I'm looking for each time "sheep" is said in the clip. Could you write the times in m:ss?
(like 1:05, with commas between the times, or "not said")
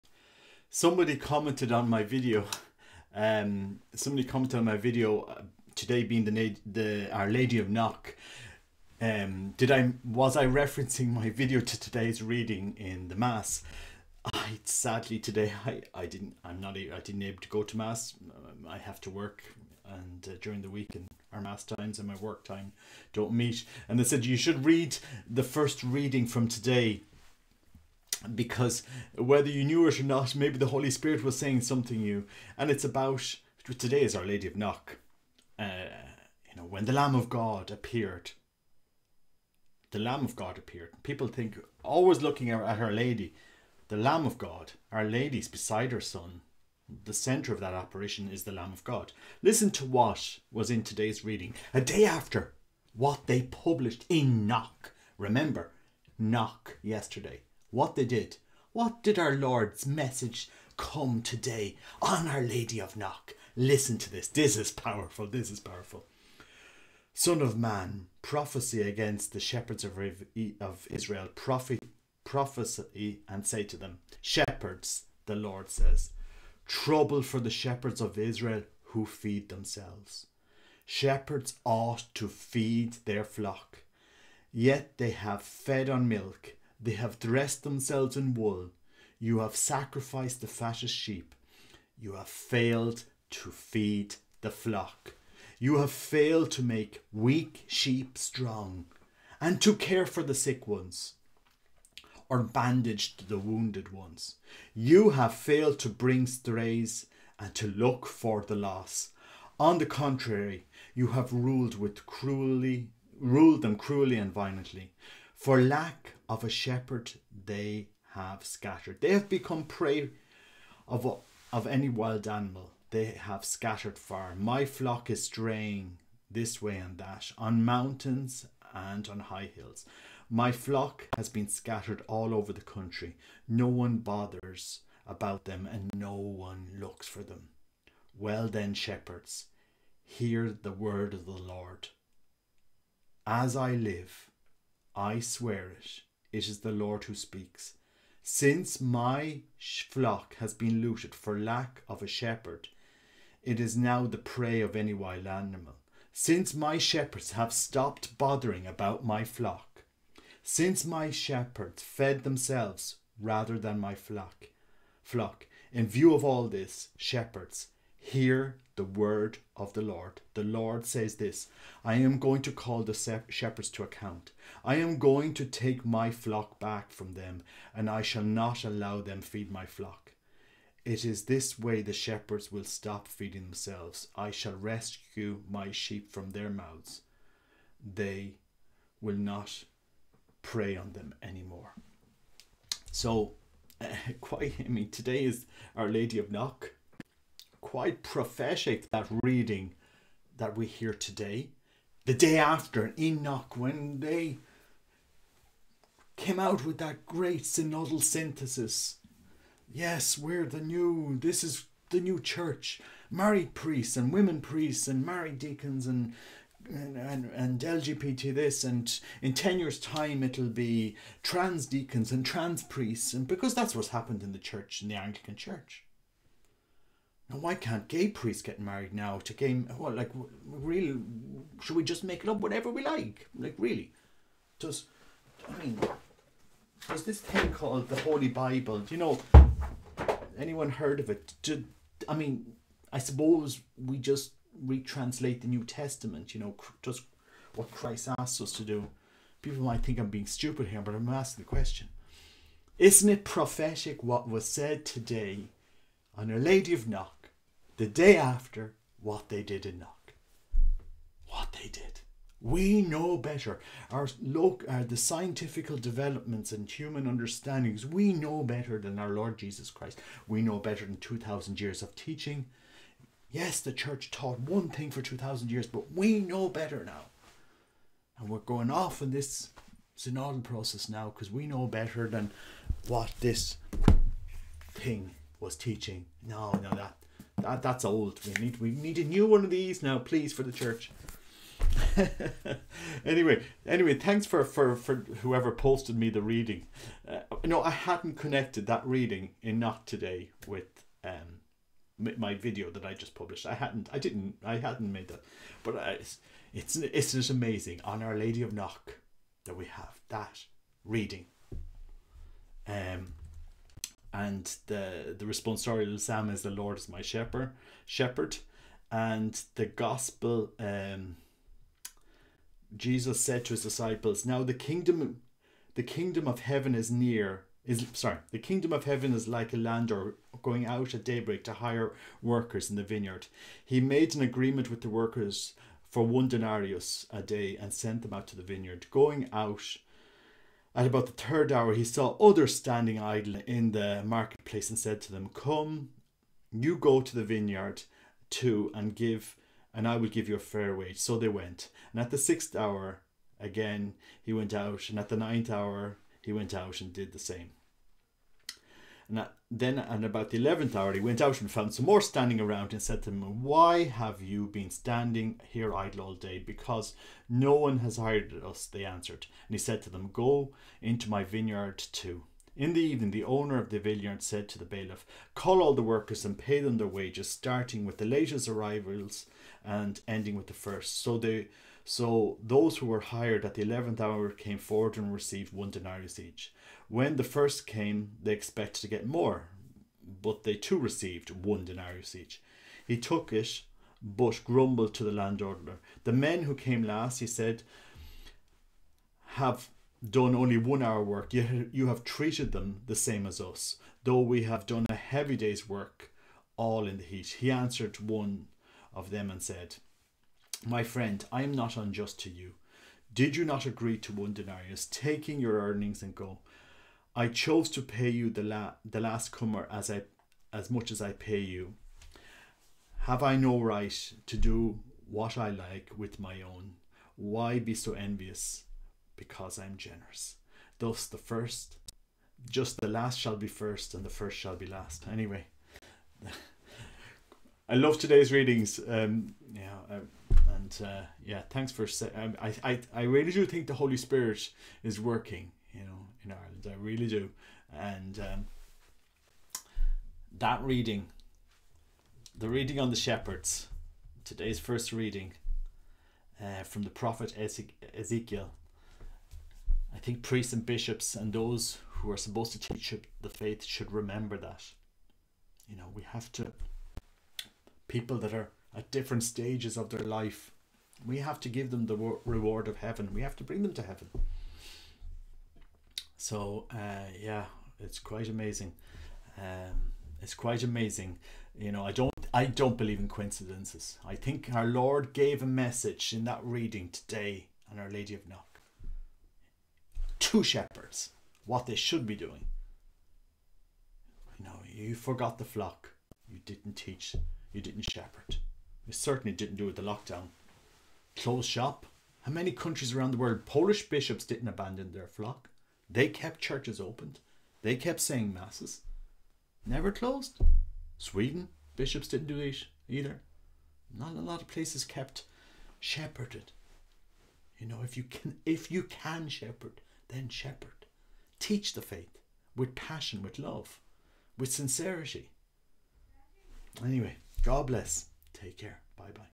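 1:30, 1:37, 3:05.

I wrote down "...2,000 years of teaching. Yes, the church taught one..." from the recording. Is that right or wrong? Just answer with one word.
right.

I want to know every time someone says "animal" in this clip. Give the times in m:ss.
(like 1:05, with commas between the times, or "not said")
2:02, 2:35.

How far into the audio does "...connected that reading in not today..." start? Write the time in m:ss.
4:58.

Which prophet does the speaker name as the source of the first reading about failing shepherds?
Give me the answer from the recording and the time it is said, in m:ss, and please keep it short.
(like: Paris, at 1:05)
Ezekiel, at 7:37.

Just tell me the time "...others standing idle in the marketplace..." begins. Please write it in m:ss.
5:42.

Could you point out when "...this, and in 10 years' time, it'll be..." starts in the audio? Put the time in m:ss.
3:38.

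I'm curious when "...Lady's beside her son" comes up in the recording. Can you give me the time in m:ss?
0:45.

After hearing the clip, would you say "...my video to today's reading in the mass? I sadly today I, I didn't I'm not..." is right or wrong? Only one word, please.
right.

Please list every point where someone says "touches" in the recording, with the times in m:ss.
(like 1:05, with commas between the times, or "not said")
not said.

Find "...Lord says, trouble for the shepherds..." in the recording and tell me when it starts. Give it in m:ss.
1:15.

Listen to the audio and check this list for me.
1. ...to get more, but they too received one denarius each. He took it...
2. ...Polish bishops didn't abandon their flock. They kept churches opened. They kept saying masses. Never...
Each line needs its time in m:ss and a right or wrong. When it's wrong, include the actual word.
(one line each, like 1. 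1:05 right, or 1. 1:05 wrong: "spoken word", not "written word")
1. 6:28 right
2. 8:23 right.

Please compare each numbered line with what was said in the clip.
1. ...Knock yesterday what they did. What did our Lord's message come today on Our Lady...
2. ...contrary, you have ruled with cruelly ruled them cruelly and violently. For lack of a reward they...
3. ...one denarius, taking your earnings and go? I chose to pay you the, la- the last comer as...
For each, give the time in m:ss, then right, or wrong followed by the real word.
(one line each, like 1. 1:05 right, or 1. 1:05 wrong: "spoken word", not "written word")
1. 0:56 right
2. 1:49 wrong: "shepherd", not "reward"
3. 6:54 right.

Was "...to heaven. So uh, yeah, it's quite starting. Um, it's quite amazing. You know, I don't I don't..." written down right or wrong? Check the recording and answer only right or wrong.
wrong.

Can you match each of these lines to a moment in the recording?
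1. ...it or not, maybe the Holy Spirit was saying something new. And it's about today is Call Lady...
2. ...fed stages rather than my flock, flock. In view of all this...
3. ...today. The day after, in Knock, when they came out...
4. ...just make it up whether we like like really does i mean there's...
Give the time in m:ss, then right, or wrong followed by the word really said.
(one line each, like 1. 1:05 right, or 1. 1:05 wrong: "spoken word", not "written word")
1. 0:29 wrong: "Our", not "Call"
2. 2:41 wrong: "themselves", not "stages"
3. 3:20 right
4. 3:51 wrong: "whatever", not "whether".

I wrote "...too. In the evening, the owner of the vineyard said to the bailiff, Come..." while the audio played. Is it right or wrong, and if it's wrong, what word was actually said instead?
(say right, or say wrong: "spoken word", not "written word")
wrong: "Call", not "Come".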